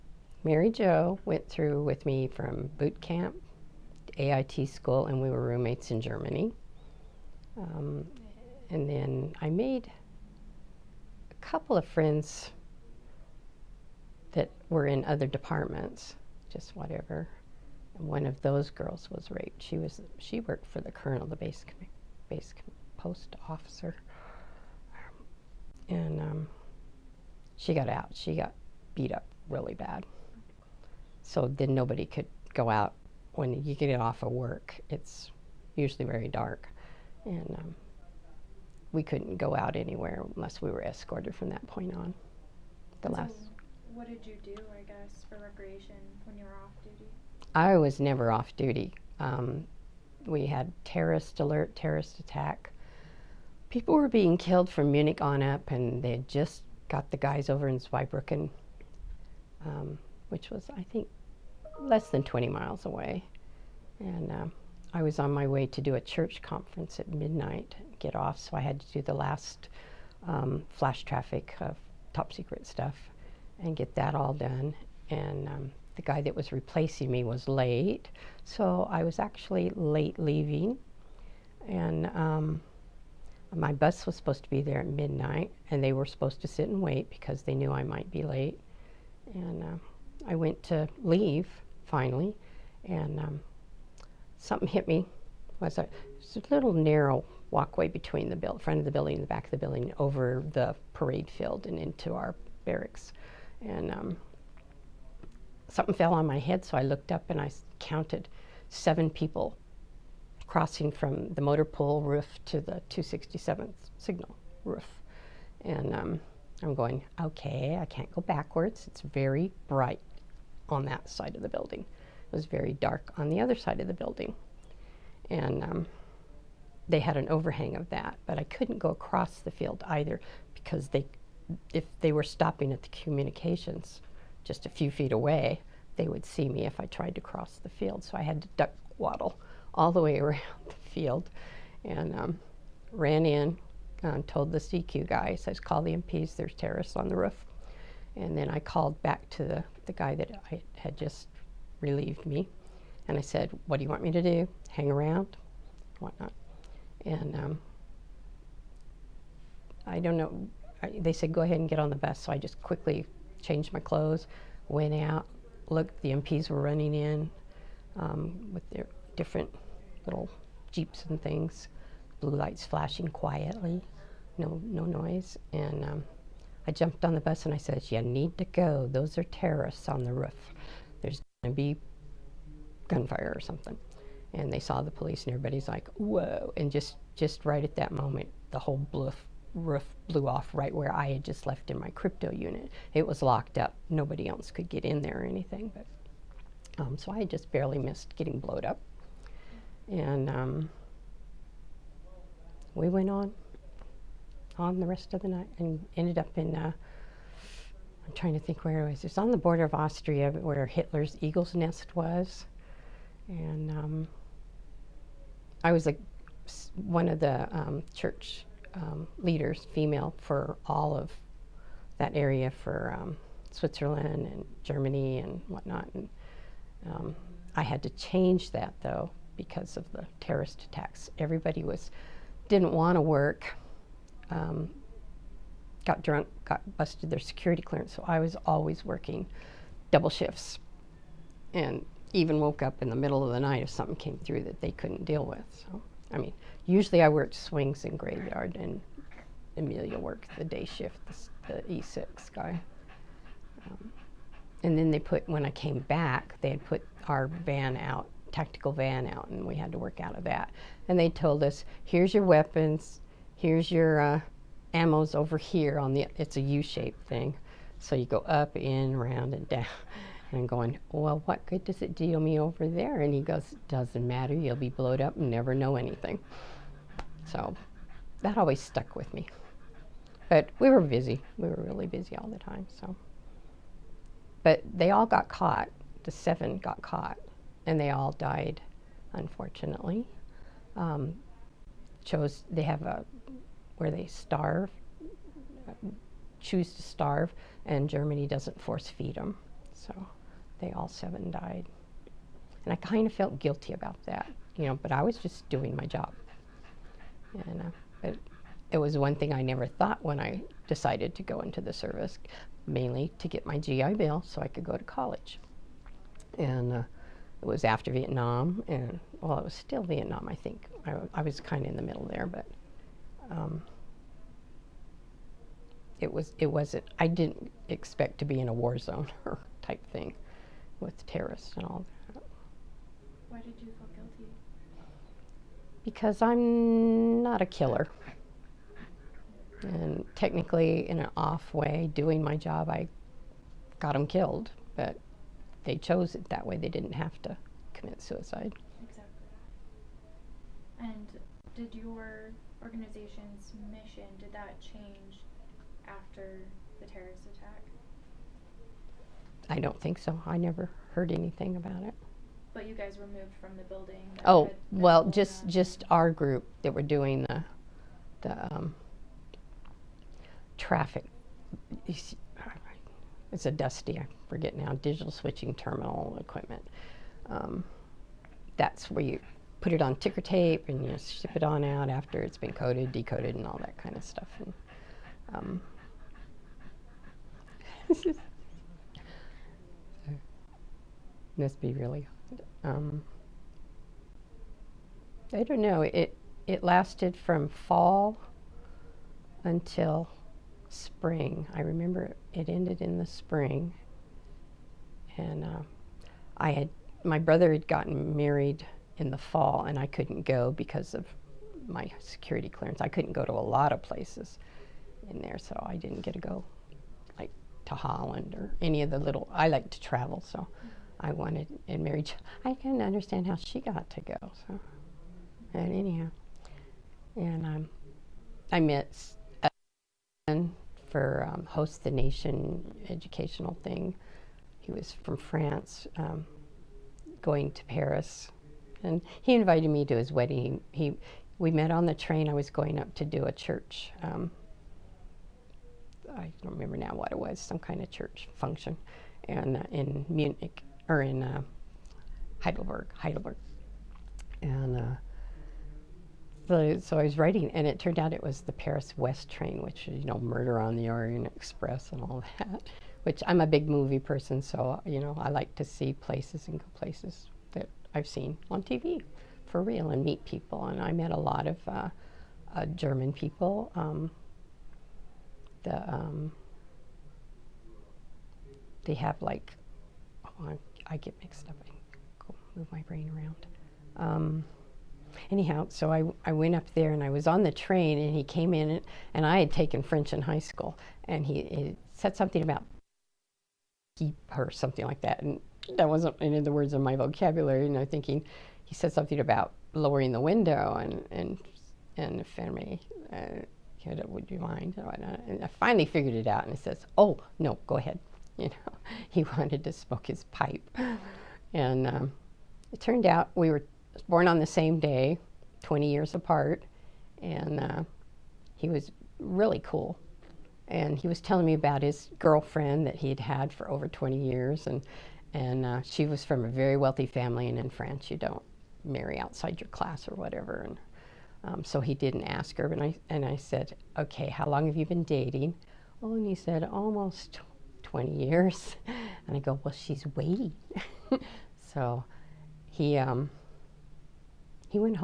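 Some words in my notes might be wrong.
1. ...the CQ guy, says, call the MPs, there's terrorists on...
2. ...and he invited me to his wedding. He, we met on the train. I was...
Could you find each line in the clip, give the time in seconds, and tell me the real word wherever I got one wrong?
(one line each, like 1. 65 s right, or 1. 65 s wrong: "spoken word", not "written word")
1. 144 s right
2. 438 s right.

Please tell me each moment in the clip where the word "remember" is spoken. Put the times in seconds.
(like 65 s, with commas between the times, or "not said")
401 s, 446 s.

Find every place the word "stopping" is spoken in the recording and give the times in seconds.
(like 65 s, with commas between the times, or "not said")
132 s.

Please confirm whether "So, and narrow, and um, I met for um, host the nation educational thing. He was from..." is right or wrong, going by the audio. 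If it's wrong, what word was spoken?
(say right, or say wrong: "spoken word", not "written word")
wrong: "anyhow", not "narrow".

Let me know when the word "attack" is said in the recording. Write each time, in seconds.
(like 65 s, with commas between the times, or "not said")
52 s, 230 s, 357 s.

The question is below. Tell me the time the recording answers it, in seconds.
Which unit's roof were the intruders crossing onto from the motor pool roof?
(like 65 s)
112 s.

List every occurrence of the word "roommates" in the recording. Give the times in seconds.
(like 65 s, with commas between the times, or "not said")
5 s.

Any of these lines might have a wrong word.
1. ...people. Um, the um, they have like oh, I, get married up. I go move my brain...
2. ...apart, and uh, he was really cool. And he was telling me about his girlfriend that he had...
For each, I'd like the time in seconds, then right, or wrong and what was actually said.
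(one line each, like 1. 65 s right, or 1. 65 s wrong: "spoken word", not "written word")
1. 473 s wrong: "mixed", not "married"
2. 516 s right.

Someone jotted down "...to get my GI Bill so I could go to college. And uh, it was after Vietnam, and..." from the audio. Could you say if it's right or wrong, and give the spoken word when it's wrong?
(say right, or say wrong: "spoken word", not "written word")
right.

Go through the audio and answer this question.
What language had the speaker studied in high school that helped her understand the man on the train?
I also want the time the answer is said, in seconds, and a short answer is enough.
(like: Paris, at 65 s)
French, at 489 s.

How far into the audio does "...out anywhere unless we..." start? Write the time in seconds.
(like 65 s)
39 s.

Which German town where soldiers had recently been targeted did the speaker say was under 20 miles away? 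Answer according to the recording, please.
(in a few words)
Zweibrücken.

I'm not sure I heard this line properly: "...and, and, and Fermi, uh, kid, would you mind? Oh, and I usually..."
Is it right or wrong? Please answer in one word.
wrong.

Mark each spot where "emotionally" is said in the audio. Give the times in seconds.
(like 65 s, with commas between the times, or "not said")
not said.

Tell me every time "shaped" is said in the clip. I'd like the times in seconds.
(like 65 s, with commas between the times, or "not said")
266 s.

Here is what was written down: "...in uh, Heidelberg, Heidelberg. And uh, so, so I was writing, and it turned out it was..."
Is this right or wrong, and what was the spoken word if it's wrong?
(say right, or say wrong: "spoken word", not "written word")
right.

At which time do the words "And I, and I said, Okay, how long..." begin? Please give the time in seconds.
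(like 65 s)
532 s.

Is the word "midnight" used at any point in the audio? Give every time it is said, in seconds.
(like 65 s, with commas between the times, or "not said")
67 s, 84 s.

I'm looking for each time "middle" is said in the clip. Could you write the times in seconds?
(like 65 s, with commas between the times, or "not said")
242 s, 321 s.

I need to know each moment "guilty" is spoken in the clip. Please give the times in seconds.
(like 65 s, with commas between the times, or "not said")
303 s, 333 s.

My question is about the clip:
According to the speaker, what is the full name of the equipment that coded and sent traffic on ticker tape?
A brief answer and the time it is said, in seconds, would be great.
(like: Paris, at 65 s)
Digital switching terminal equipment, at 374 s.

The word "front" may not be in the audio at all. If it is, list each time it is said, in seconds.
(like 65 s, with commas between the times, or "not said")
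98 s.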